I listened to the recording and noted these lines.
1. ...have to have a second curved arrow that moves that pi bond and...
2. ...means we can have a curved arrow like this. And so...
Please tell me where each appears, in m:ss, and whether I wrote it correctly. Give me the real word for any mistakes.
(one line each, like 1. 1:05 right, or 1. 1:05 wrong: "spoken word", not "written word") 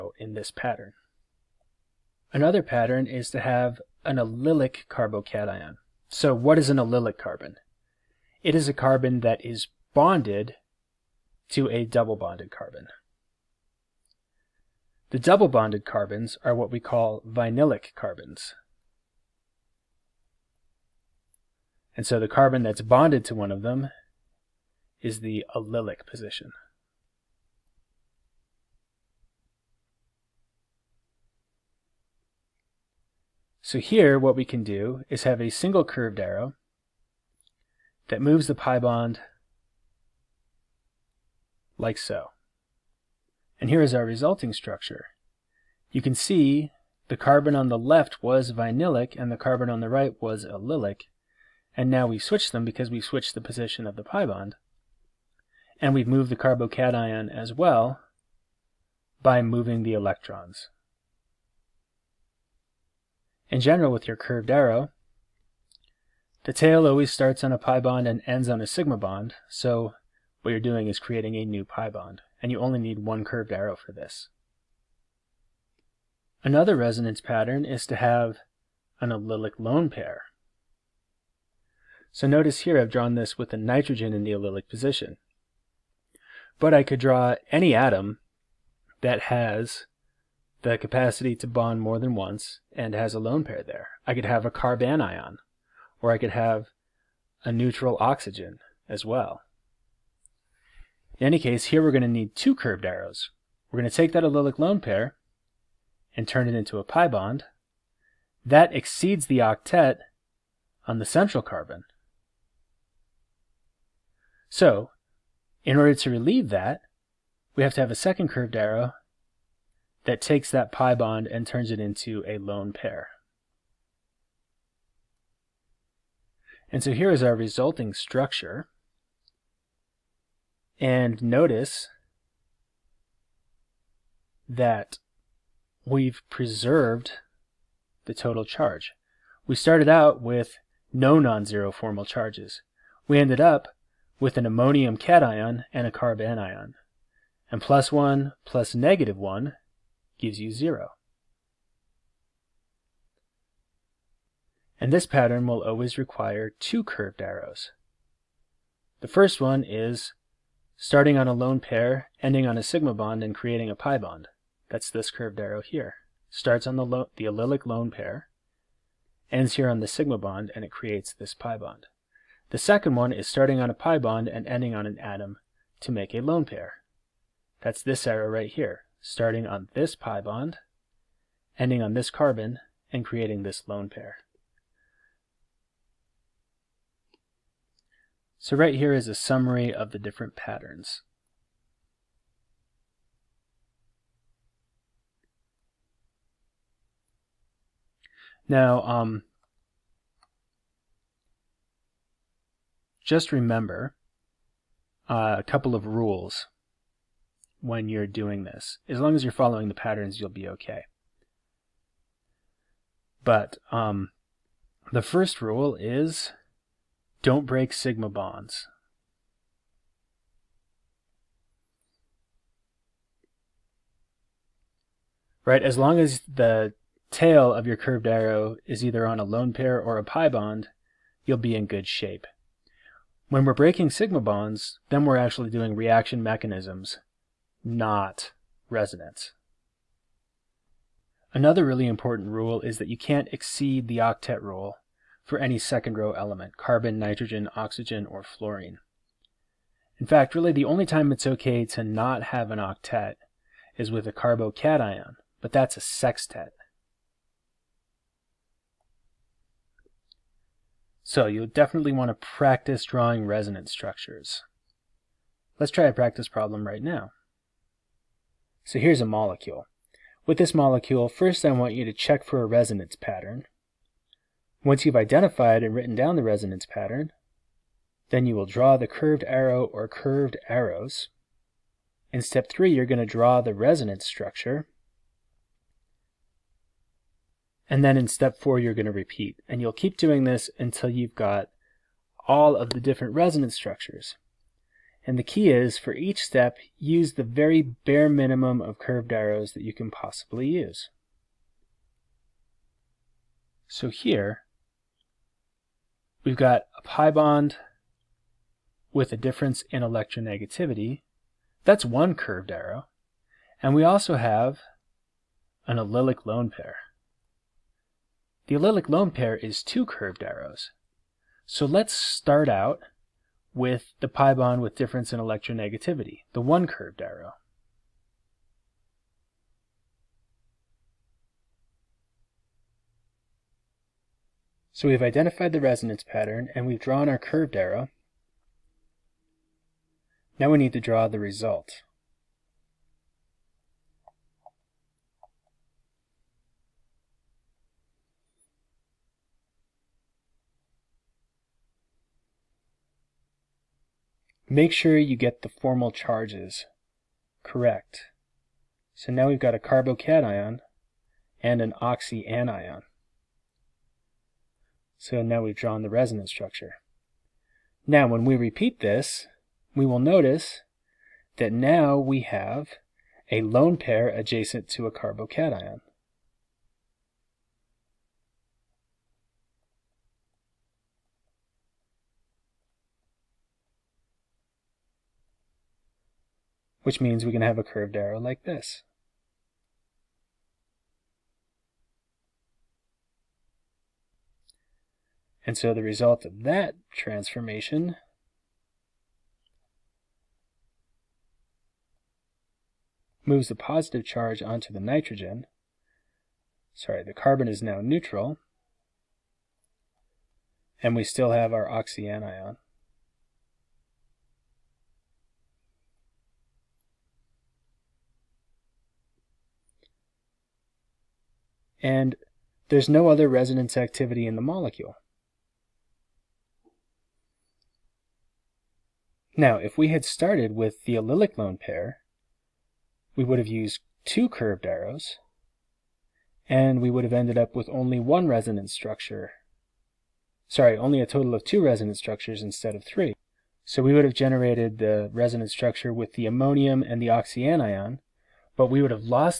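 1. 1:57 wrong: "takes", not "moves"
2. 6:27 right.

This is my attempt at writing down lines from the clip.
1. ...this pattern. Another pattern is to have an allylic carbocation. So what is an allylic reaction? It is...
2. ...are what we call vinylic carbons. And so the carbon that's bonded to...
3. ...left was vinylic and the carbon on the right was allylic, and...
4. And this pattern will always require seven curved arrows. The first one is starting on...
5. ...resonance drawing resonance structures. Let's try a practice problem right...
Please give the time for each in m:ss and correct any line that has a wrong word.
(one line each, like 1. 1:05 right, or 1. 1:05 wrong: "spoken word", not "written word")
1. 0:00 wrong: "carbon", not "reaction"
2. 0:16 right
3. 0:47 right
4. 2:34 wrong: "two", not "seven"
5. 4:22 wrong: "practice", not "resonance".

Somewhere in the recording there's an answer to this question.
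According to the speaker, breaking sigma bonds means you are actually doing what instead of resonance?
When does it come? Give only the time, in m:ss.
3:55.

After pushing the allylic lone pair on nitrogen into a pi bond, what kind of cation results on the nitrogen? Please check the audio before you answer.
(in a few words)
Ammonium cation.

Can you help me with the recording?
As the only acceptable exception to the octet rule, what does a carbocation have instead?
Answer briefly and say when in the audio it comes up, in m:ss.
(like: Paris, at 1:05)
A sextet, at 4:15.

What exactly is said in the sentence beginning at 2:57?
That's this arrow right here, starting on this pi bond, ending on this carbon, and creating this lone pair.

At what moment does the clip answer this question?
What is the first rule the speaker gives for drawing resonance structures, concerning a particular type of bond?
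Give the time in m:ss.
3:37.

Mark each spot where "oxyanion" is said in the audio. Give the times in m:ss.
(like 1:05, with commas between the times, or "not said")
6:01, 6:51, 7:27.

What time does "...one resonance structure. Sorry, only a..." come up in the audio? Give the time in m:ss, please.
7:17.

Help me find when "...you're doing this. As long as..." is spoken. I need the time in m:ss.
3:27.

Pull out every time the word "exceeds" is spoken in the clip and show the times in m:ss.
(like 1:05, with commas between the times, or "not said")
1:48, 4:03.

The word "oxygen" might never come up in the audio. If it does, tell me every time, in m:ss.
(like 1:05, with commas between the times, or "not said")
1:38, 4:07.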